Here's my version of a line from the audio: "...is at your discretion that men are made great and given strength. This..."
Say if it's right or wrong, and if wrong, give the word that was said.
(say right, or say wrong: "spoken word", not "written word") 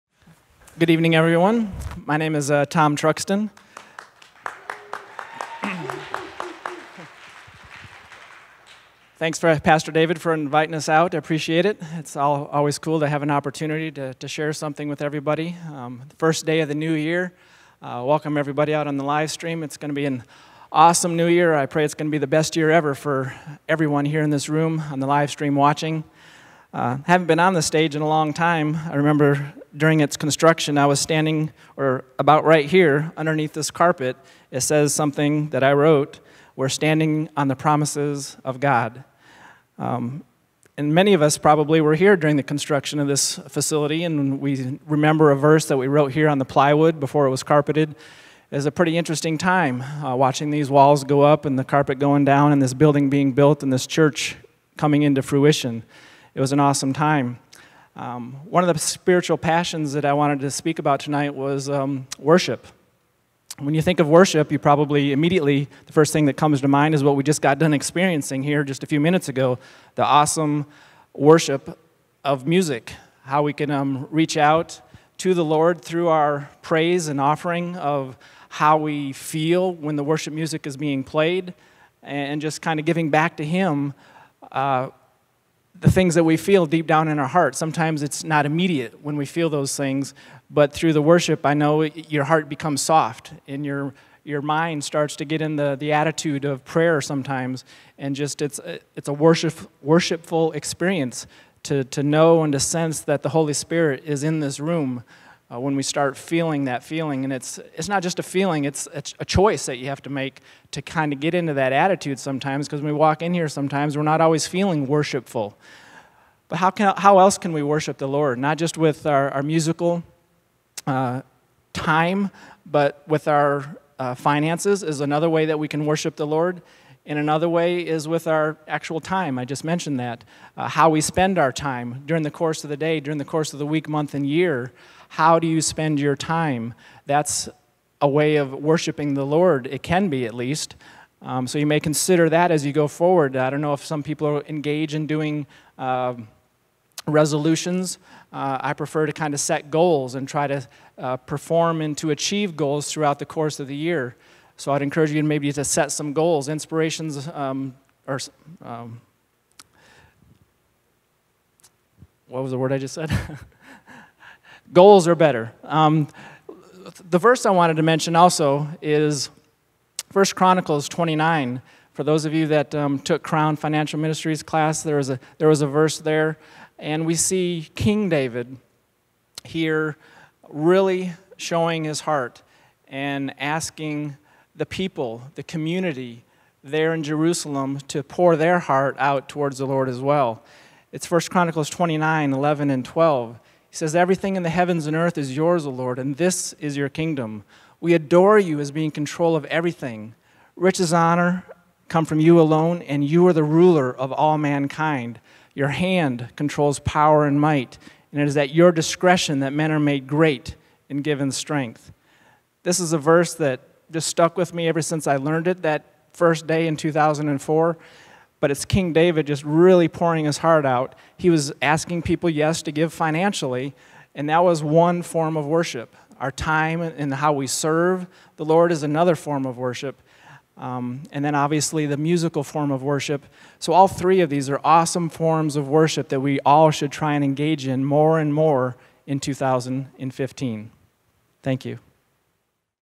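right.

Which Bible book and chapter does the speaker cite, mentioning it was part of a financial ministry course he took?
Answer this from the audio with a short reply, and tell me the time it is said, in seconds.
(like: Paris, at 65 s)
First Chronicles 29, at 170 s.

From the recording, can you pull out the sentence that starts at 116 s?
But how, can, how else can we worship the Lord?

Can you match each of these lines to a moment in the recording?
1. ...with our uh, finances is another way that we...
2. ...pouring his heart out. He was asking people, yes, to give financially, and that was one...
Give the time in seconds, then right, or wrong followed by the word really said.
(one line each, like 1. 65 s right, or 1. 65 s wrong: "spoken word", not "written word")
1. 123 s right
2. 219 s right.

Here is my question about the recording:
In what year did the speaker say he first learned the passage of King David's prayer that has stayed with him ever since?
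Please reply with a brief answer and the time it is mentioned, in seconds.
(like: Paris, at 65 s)
2004, at 216 s.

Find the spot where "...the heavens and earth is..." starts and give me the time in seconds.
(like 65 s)
194 s.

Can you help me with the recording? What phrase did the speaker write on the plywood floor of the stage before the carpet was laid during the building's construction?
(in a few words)
We're standing on the promises of God.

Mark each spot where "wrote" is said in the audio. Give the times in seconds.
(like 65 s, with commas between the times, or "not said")
35 s, 45 s.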